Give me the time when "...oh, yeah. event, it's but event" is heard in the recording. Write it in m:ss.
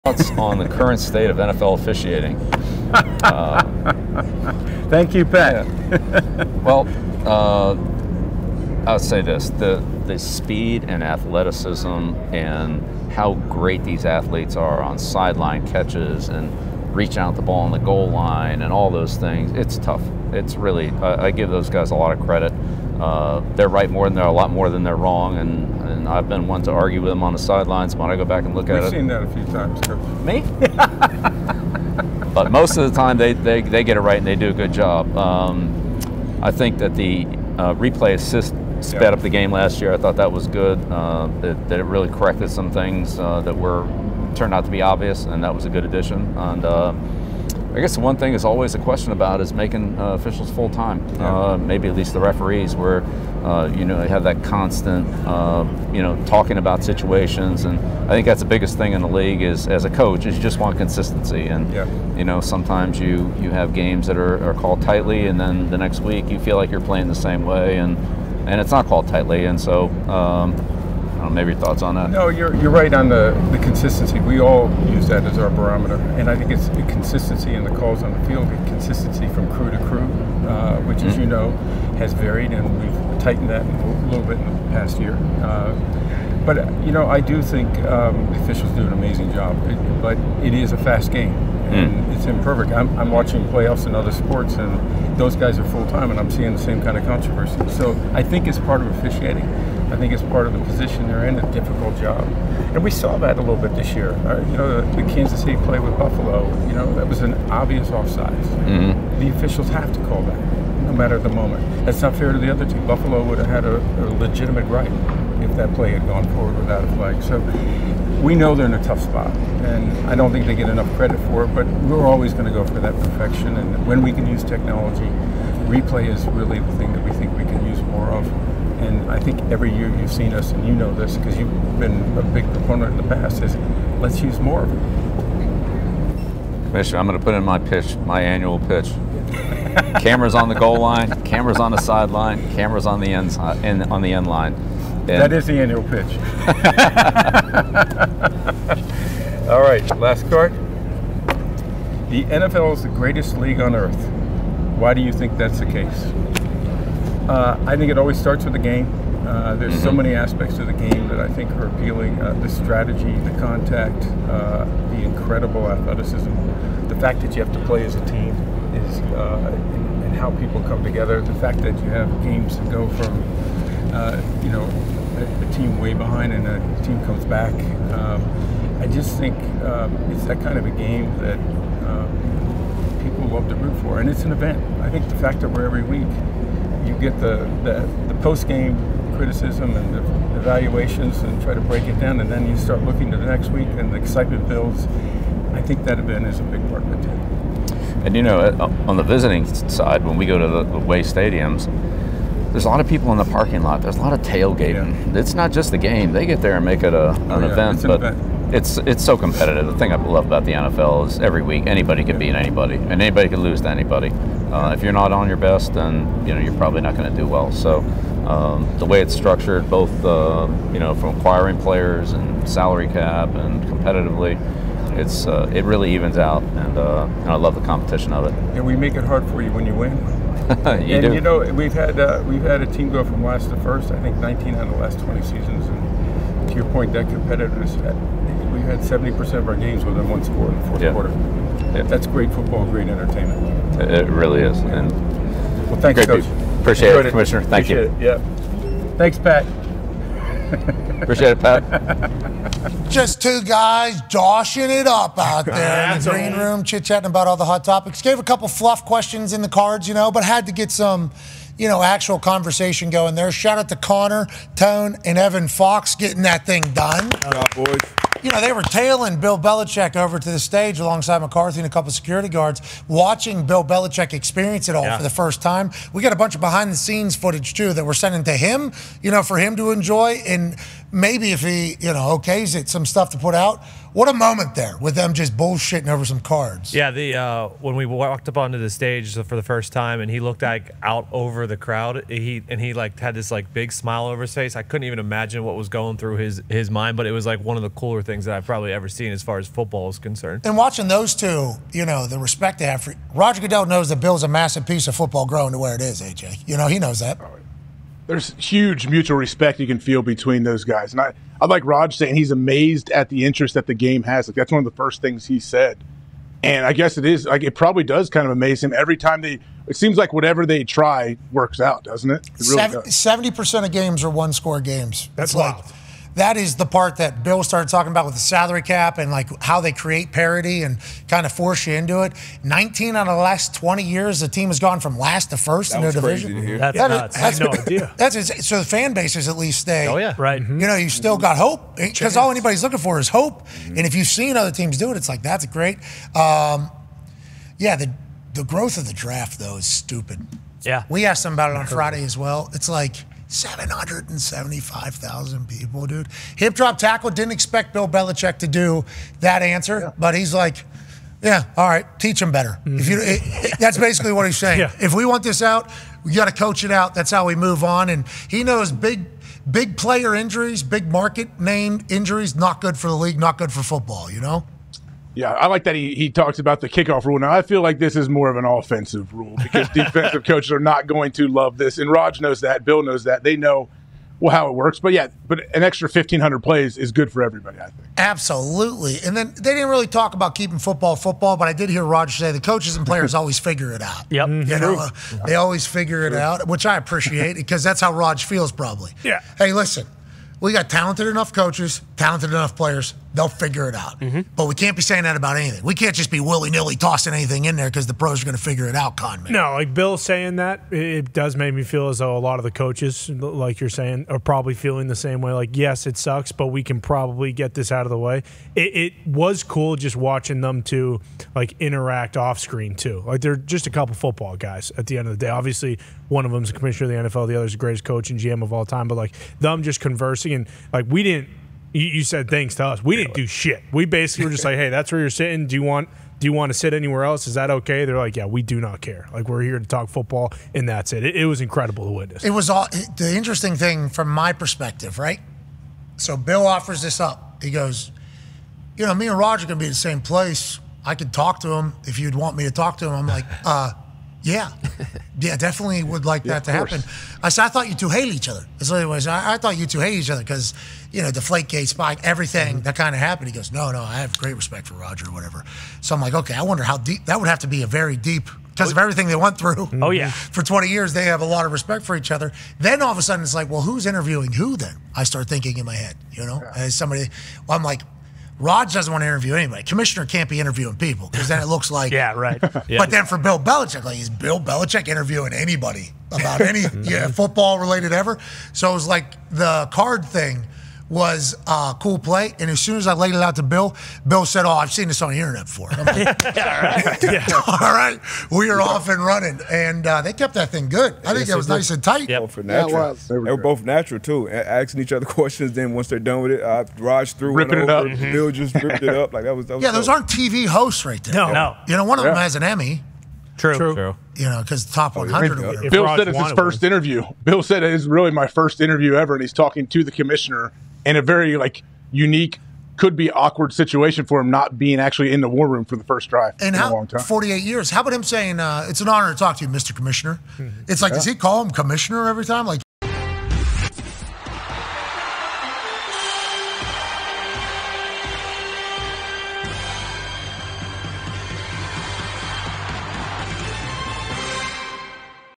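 3:27.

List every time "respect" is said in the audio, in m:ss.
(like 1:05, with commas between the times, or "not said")
5:02, 5:09, 7:44, 7:51.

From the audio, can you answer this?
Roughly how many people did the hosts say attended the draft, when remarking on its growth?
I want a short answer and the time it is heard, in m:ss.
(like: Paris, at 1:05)
775,000, at 5:53.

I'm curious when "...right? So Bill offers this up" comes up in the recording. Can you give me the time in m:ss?
7:24.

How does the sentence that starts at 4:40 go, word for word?
And maybe if he, you know, okays it, some stuff to put out.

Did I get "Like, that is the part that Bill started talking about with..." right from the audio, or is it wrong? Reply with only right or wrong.
right.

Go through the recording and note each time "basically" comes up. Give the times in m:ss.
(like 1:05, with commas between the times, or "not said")
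6:03, 7:13.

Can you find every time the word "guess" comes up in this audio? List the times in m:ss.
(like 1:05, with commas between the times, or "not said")
0:47, 5:16.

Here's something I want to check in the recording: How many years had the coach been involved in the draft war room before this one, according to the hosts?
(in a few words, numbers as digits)
48 years.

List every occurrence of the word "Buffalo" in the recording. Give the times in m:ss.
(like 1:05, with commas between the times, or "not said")
1:45, 1:52.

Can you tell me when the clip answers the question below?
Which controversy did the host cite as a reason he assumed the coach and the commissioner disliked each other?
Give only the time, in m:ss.
7:41.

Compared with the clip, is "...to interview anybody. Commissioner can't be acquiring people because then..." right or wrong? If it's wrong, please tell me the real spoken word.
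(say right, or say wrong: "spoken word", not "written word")
wrong: "interviewing", not "acquiring".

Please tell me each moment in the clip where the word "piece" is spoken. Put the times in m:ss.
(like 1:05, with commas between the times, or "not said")
5:04.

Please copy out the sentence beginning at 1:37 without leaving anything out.
So I think it's part of officiating I think it's part of the position they're in, a difficult job.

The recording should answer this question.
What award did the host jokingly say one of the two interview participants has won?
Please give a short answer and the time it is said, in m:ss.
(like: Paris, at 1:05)
Emmy, at 8:32.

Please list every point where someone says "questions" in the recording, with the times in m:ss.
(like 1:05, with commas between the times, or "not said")
0:48, 4:18, 8:25.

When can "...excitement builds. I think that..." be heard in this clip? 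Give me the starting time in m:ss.
3:13.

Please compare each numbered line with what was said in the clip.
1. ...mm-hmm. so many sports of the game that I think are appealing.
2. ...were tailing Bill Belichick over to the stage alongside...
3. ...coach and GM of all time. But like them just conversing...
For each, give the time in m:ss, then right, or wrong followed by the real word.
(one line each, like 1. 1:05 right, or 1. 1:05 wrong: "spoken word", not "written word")
1. 2:39 wrong: "aspects", not "sports"
2. 4:28 right
3. 7:07 right.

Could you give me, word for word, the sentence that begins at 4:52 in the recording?
He and he like had this like big smile over his face.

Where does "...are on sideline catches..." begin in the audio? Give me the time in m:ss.
0:14.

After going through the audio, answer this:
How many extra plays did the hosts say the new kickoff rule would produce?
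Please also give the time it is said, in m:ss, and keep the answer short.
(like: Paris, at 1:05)
1,500, at 6:25.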